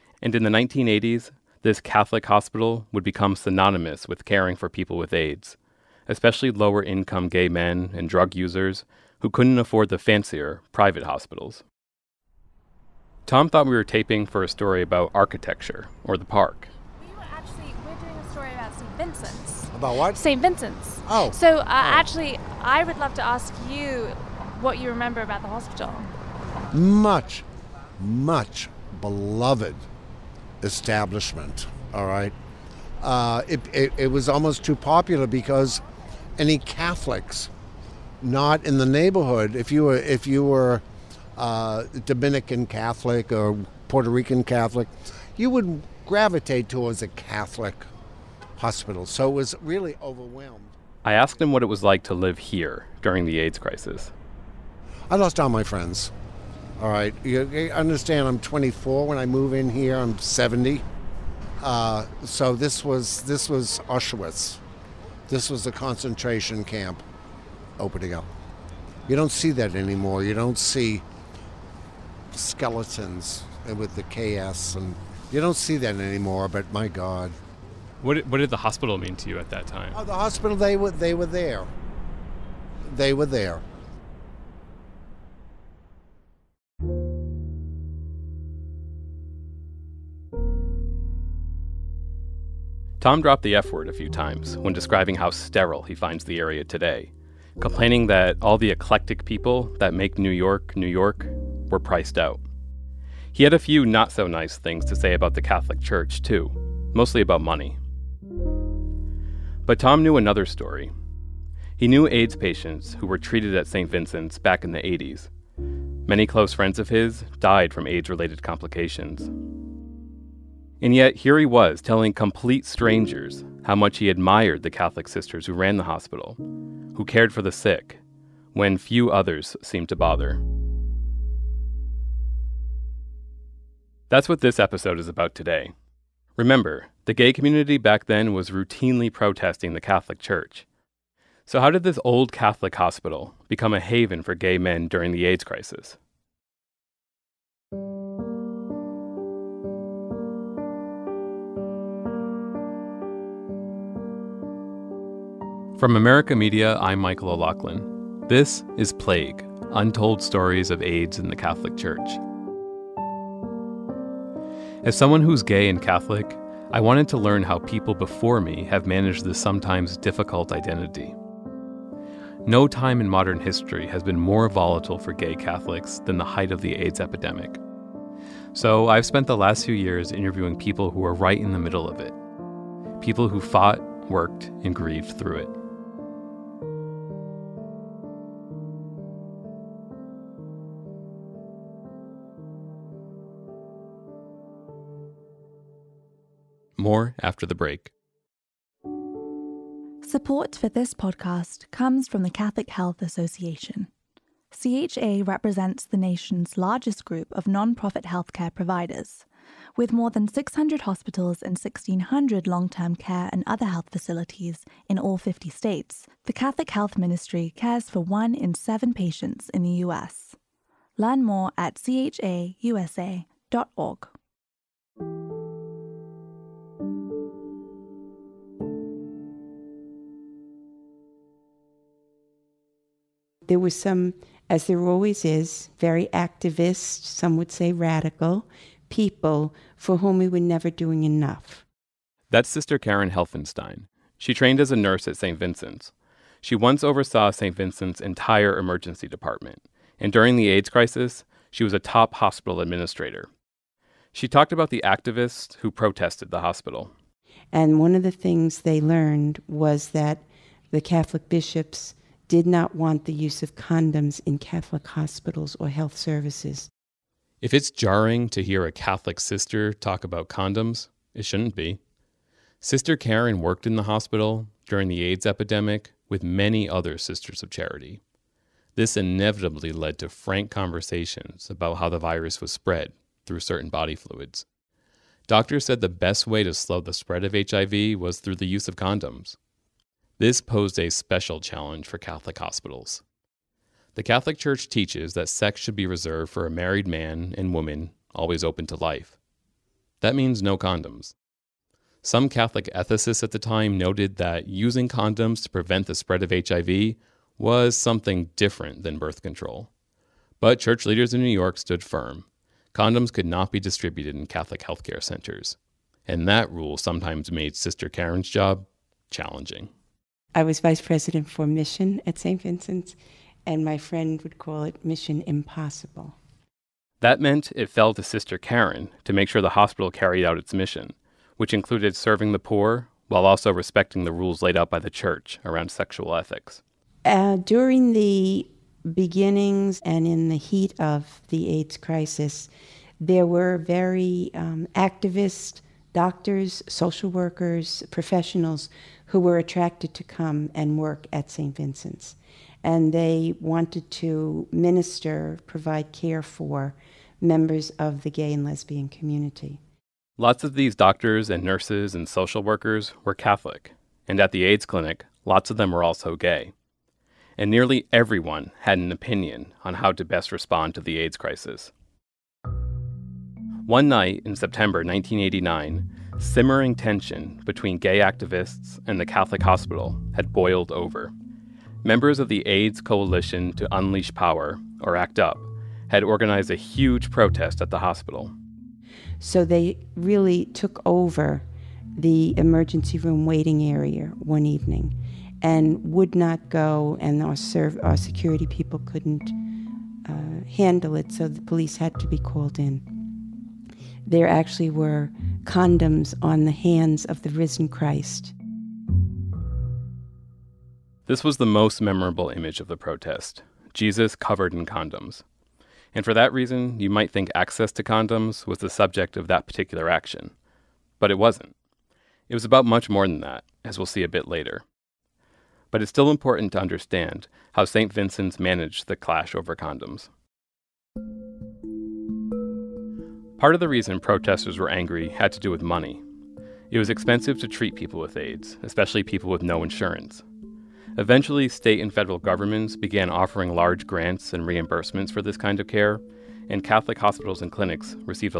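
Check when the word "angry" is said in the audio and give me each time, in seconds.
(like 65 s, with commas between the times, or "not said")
434 s.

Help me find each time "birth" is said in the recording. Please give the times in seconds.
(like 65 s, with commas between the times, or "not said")
308 s.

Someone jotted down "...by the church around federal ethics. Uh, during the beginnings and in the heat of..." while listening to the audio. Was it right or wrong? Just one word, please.
wrong.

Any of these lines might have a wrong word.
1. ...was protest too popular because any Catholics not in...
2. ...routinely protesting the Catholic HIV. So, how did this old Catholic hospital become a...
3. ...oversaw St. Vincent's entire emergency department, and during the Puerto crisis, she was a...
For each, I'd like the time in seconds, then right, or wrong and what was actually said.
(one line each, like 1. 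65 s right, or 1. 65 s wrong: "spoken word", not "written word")
1. 34 s wrong: "almost", not "protest"
2. 138 s wrong: "Church", not "HIV"
3. 246 s wrong: "AIDS", not "Puerto".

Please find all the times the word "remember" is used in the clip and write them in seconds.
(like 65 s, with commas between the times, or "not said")
24 s, 136 s.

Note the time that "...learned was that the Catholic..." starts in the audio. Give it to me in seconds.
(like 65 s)
258 s.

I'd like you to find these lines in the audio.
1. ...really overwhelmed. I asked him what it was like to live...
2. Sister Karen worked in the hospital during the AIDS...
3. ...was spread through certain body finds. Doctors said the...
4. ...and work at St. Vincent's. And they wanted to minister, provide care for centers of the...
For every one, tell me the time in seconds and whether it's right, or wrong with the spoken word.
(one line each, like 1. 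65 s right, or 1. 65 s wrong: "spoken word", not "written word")
1. 49 s right
2. 272 s right
3. 282 s wrong: "fluids", not "finds"
4. 350 s wrong: "members", not "centers".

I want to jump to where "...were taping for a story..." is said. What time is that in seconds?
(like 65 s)
13 s.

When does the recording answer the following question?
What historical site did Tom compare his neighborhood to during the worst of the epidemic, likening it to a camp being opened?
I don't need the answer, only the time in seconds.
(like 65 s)
63 s.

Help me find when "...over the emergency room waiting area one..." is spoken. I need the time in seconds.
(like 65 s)
390 s.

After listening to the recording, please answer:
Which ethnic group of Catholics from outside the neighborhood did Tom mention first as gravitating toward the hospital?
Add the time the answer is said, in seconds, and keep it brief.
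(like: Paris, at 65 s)
Dominican, at 42 s.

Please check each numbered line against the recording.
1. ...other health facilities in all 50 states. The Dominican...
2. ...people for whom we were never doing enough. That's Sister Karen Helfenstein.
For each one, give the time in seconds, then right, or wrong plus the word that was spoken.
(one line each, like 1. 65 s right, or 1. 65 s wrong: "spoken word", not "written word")
1. 213 s wrong: "Catholic", not "Dominican"
2. 238 s right.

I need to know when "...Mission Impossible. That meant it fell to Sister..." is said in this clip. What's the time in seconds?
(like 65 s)
324 s.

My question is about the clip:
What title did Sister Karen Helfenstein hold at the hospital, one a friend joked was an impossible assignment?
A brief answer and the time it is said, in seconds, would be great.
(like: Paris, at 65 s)
vice president for mission, at 320 s.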